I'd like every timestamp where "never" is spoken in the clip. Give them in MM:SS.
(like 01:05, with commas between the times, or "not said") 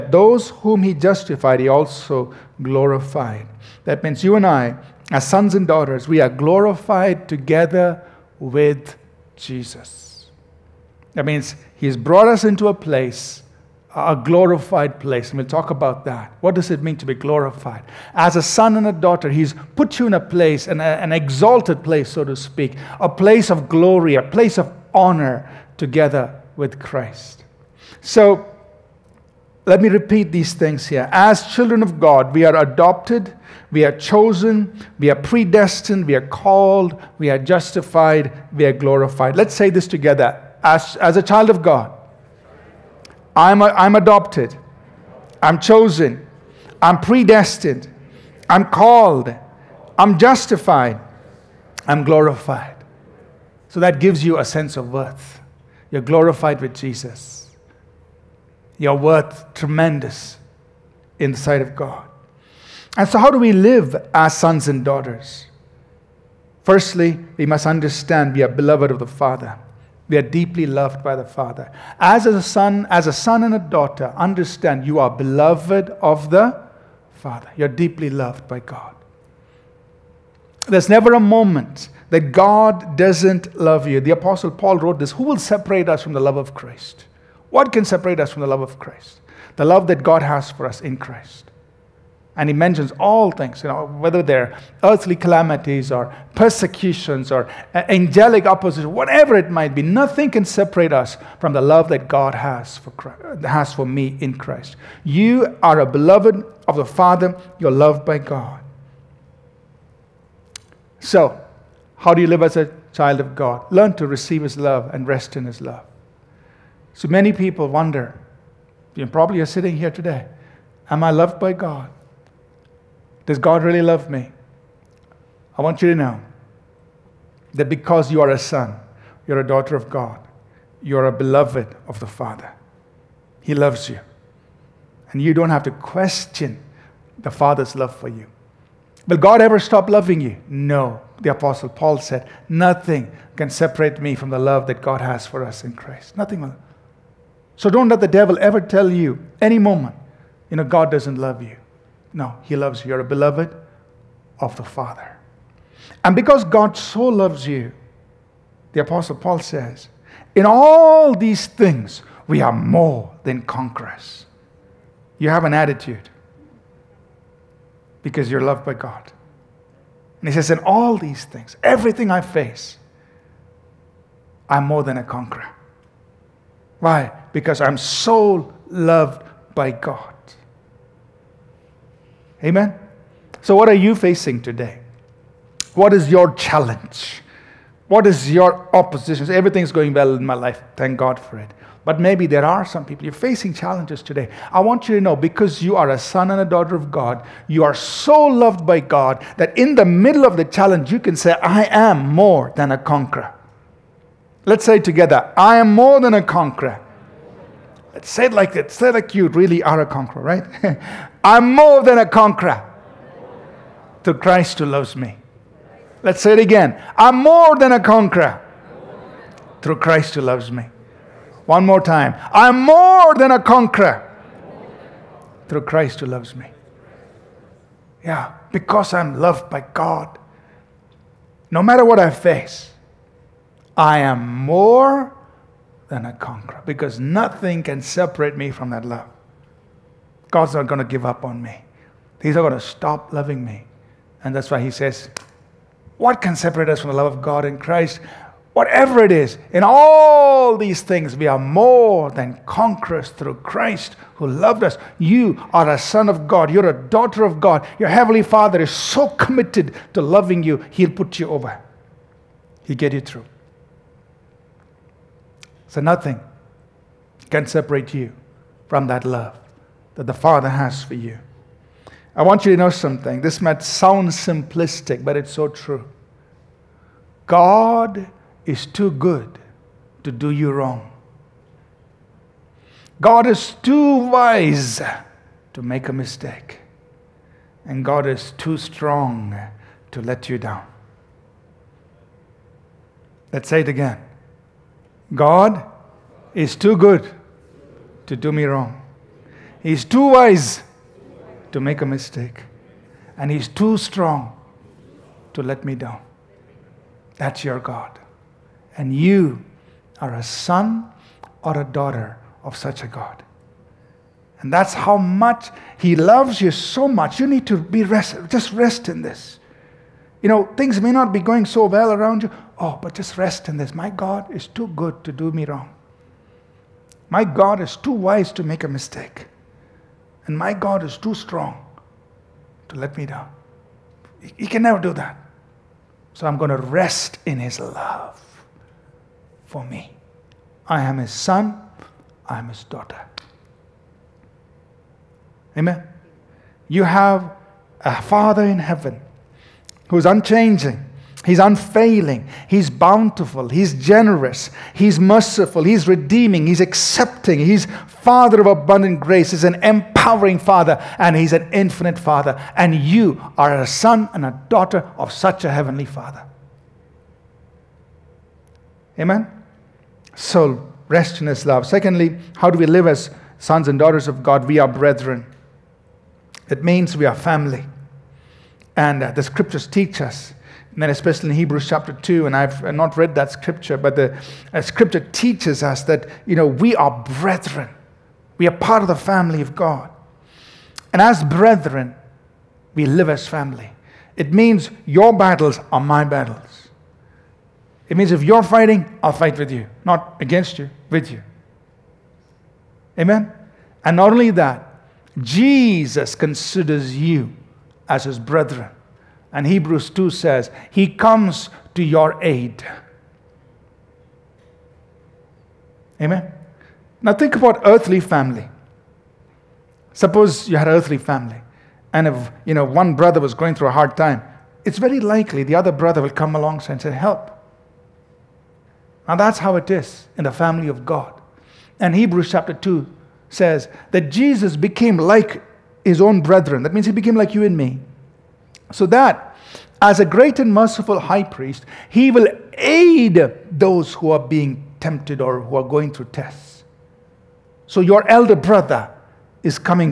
01:20, 05:34.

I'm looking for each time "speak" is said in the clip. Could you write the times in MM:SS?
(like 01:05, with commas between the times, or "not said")
00:22.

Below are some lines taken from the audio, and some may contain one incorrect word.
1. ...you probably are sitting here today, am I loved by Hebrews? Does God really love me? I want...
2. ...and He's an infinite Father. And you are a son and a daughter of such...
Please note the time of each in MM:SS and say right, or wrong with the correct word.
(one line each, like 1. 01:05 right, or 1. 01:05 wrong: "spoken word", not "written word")
1. 01:58 wrong: "God", not "Hebrews"
2. 06:00 right.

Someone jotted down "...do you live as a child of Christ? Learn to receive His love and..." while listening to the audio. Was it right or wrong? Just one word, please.
wrong.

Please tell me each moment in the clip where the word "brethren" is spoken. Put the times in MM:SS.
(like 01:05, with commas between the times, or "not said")
06:14, 06:27, 06:31, 06:48, 07:16.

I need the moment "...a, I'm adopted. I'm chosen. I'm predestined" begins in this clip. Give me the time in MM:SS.
00:43.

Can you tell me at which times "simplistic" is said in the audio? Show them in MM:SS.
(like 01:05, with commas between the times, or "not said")
04:34.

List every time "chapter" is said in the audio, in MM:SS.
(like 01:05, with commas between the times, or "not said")
06:21, 07:12.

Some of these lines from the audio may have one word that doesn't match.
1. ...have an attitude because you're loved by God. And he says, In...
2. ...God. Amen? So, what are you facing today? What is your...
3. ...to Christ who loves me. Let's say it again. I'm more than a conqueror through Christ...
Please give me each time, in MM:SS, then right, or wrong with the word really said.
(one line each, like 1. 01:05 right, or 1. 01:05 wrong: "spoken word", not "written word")
1. 02:45 right
2. 02:59 right
3. 03:34 right.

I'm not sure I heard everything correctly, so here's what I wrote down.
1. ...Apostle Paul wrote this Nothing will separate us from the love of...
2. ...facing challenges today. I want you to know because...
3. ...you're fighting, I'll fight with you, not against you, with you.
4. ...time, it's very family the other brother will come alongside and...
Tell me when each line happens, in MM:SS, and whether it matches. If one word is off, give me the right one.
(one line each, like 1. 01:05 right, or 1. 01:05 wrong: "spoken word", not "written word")
1. 01:24 wrong: "Who", not "Nothing"
2. 03:13 right
3. 06:38 right
4. 07:03 wrong: "likely", not "family".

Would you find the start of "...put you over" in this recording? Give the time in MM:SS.
04:20.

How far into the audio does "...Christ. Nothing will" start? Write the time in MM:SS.
02:25.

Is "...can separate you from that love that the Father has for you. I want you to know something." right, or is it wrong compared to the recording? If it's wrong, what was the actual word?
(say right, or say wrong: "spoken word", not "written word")
right.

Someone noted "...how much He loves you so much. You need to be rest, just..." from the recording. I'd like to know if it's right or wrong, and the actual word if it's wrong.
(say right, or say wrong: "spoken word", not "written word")
right.